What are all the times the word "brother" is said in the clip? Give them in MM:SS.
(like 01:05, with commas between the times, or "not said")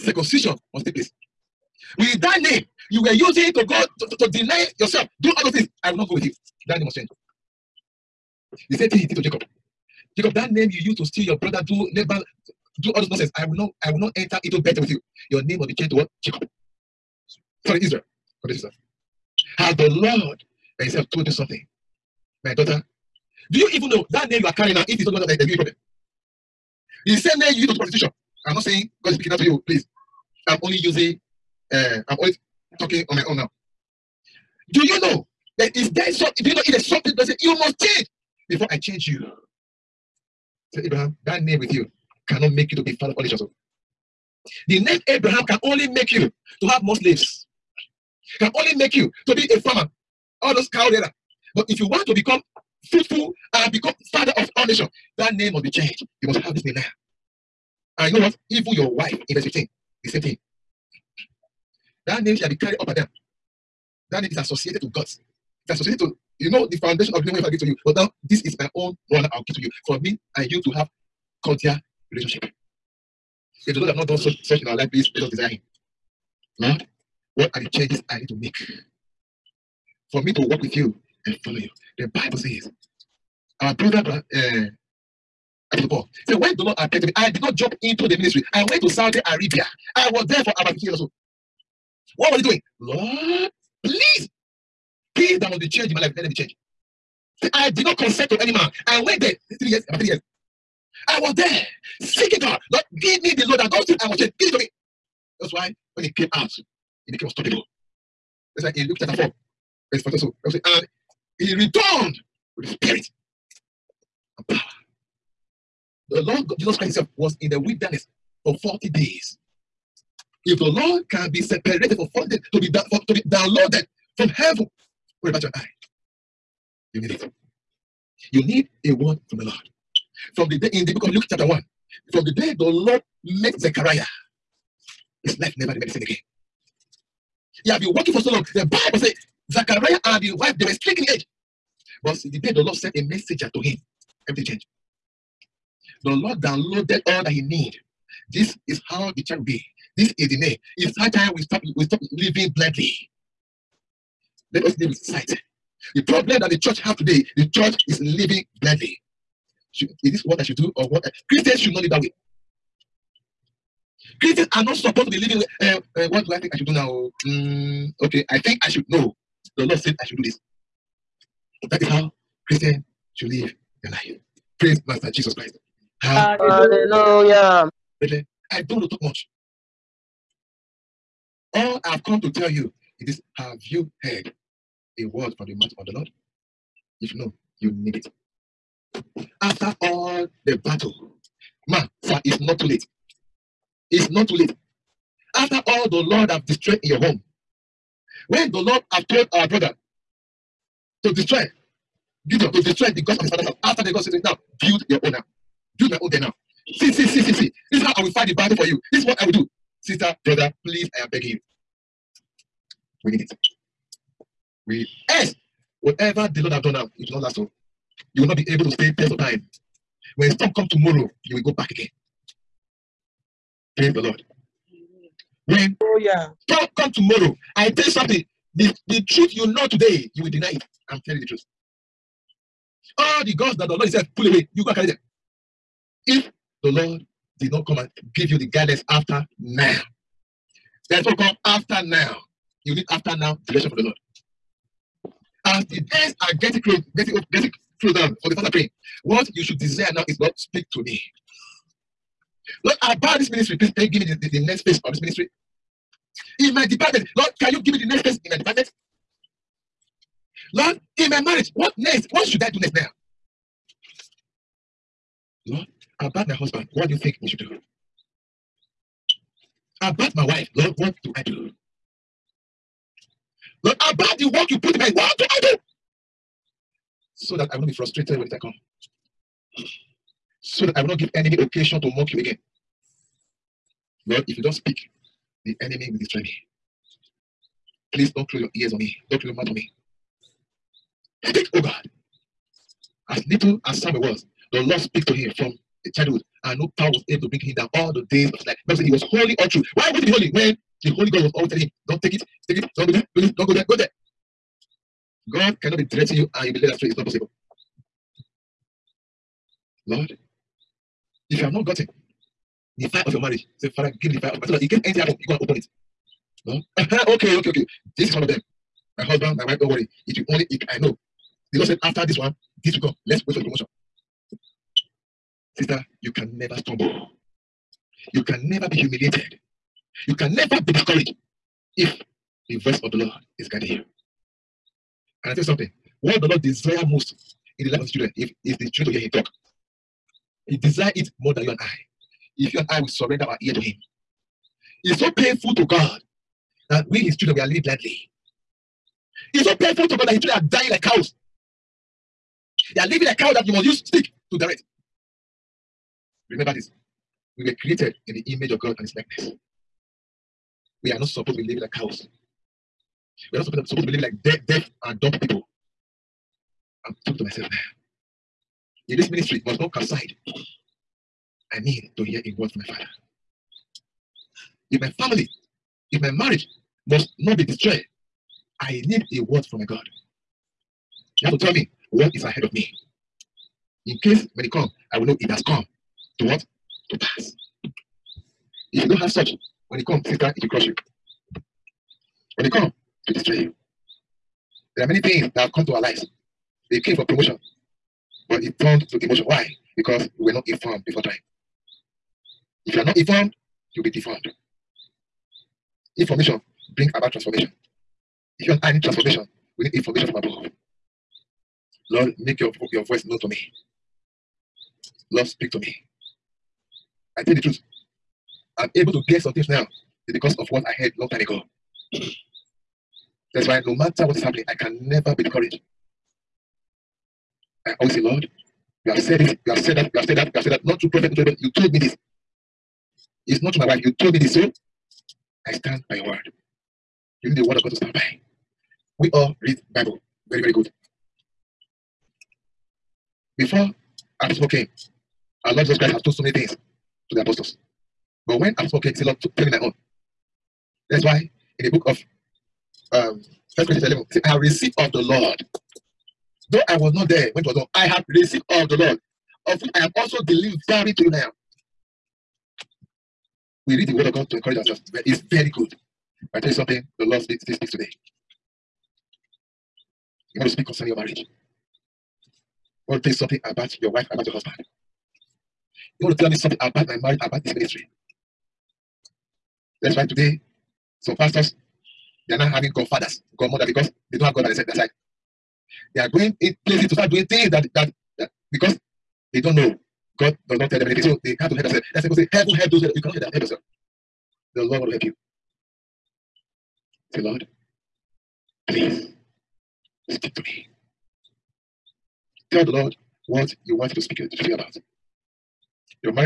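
00:11, 01:23, 03:19, 03:30.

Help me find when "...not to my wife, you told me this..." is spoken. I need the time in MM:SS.
07:13.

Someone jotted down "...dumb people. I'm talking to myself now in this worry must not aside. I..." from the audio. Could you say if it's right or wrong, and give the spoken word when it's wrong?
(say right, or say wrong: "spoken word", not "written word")
wrong: "ministry", not "worry".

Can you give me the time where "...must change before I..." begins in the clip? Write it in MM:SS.
00:37.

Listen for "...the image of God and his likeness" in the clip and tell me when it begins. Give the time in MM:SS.
05:58.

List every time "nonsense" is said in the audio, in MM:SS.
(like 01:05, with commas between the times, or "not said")
00:13.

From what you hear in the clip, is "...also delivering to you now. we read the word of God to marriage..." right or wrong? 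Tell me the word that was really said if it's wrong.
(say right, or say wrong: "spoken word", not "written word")
wrong: "encourage", not "marriage".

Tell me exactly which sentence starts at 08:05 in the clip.
They are going in places to start doing things that, that, that because they don't know God does not tell them anything.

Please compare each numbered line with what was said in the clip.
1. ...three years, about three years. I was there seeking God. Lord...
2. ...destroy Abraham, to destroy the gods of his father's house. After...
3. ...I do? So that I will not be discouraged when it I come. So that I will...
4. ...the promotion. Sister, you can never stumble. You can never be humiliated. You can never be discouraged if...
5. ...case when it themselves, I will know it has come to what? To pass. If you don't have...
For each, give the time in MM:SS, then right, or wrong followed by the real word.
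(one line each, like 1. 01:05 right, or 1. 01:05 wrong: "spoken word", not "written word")
1. 01:39 right
2. 03:21 wrong: "Gideon", not "Abraham"
3. 04:35 wrong: "frustrated", not "discouraged"
4. 05:23 right
5. 06:24 wrong: "comes", not "themselves".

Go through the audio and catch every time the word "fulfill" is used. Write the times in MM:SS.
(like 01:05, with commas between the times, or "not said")
not said.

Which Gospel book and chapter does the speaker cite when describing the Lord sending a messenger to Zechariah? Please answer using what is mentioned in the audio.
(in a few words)
Luke chapter 1.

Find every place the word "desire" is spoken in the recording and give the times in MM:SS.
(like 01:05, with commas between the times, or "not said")
01:15, 04:09, 05:36, 05:40.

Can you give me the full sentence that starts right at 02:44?
Christians are not supposed to be living with.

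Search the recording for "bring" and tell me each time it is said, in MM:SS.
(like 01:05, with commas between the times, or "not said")
04:57, 06:46.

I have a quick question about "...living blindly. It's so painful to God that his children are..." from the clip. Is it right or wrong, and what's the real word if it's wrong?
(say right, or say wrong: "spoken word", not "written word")
right.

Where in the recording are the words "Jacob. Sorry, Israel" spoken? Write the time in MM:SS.
00:16.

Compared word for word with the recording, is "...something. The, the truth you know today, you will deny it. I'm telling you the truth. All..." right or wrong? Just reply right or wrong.
right.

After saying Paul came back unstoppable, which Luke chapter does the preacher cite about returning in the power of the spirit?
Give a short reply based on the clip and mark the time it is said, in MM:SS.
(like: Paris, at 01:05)
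Luke chapter 4, at 01:48.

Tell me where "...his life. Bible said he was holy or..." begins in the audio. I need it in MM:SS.
04:58.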